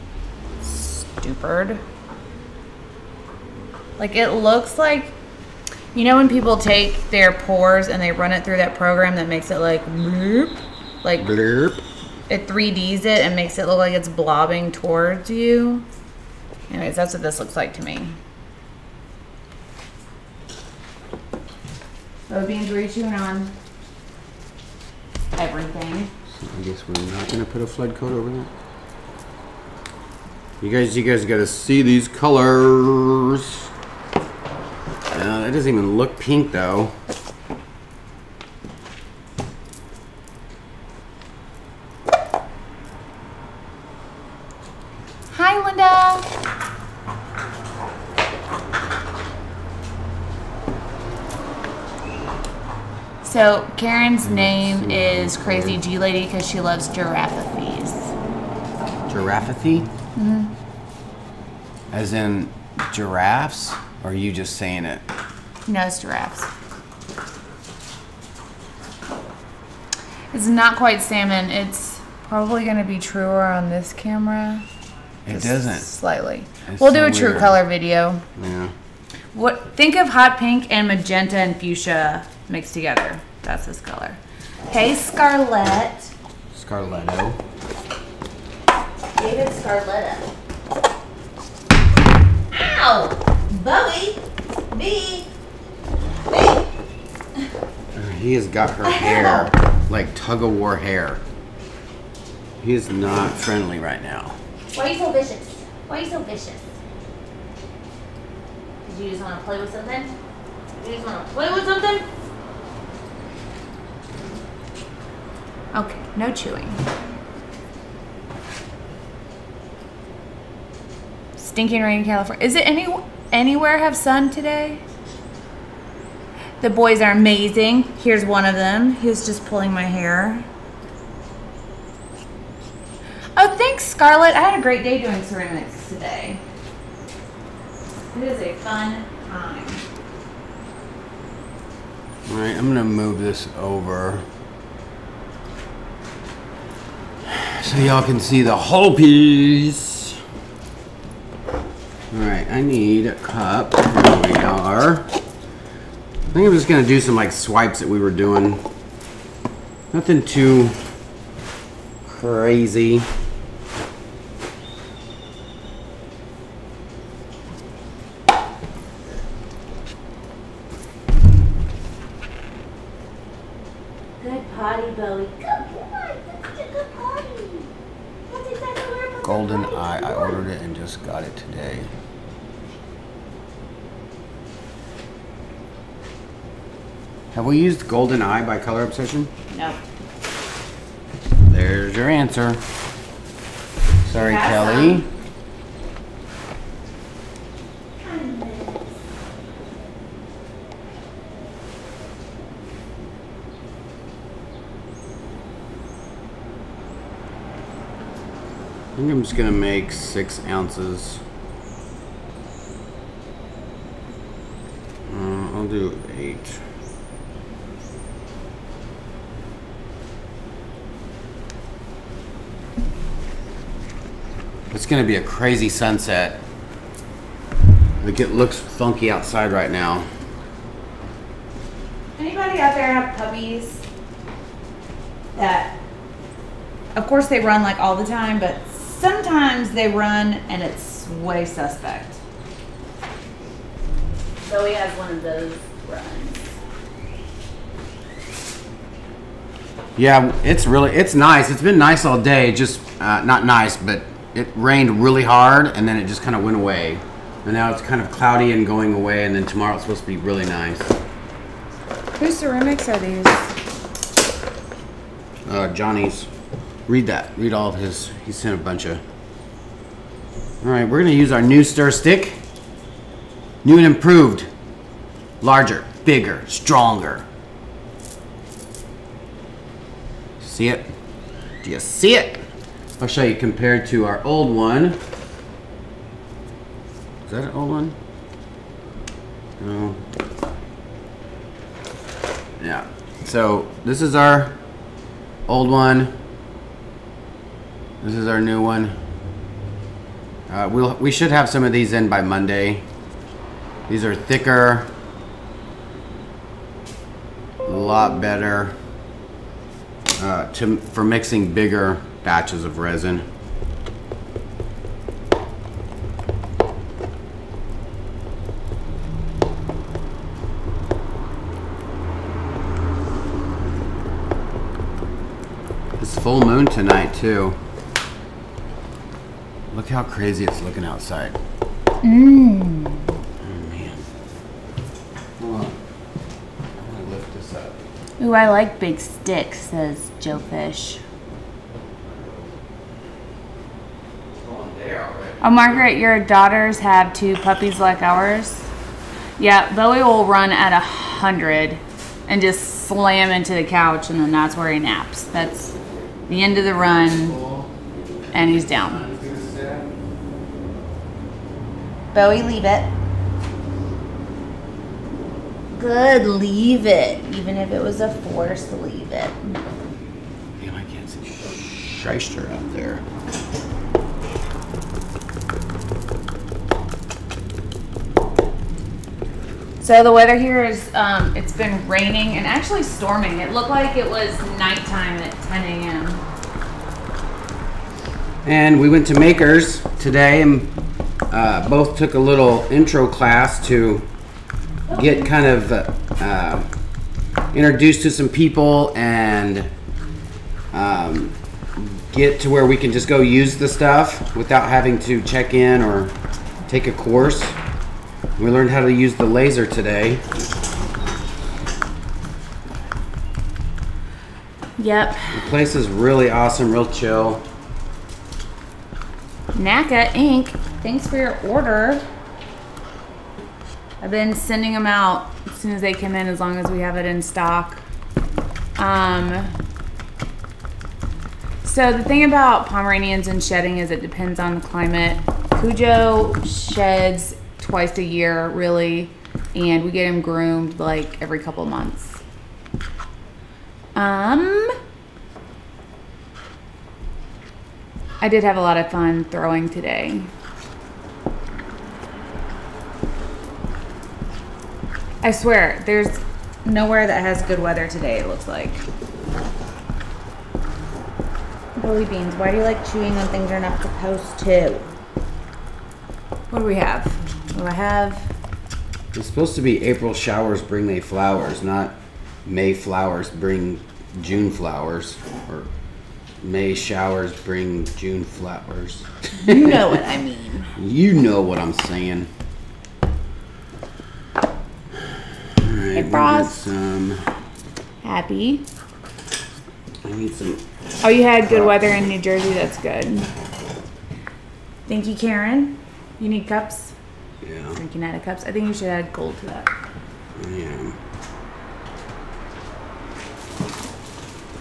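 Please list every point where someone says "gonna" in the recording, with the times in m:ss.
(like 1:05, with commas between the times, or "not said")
0:27, 2:36, 3:29, 3:44.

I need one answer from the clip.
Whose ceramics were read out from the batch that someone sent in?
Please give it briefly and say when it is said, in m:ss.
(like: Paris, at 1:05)
Johnny's, at 4:25.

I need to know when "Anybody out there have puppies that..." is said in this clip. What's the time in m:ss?
3:52.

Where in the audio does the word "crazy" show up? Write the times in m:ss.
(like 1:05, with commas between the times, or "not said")
0:55, 2:42, 3:45, 5:30.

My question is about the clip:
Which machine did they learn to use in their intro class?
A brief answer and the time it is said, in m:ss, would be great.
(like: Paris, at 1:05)
The laser, at 6:49.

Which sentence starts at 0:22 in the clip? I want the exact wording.
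Oh, beans, were chewing on everything?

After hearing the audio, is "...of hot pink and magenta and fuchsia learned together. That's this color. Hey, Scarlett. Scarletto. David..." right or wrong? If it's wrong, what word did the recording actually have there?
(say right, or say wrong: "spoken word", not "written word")
wrong: "mixed", not "learned".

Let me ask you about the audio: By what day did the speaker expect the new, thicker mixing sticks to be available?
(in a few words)
Monday.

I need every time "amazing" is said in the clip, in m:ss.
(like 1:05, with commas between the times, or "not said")
2:07.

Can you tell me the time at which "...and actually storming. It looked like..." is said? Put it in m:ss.
6:22.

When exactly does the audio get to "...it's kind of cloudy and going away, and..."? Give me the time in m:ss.
4:17.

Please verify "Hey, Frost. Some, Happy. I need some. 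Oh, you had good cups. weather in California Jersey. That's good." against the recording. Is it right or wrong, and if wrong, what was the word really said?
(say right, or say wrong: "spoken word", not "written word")
wrong: "New", not "California".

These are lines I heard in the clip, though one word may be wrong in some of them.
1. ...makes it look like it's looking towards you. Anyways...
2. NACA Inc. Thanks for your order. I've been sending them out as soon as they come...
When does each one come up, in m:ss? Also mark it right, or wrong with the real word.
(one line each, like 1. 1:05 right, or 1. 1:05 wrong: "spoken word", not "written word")
1. 0:13 wrong: "blobbing", not "looking"
2. 6:59 right.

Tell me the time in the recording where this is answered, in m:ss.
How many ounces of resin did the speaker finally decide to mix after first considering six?
3:36.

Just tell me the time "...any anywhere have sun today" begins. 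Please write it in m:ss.
2:02.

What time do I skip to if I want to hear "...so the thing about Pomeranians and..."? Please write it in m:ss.
7:11.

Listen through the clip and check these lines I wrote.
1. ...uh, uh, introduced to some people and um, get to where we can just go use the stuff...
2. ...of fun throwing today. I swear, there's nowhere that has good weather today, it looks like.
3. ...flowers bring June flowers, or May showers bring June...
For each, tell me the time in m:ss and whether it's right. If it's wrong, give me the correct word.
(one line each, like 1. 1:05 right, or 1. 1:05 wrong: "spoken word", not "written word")
1. 6:35 right
2. 7:28 right
3. 7:52 right.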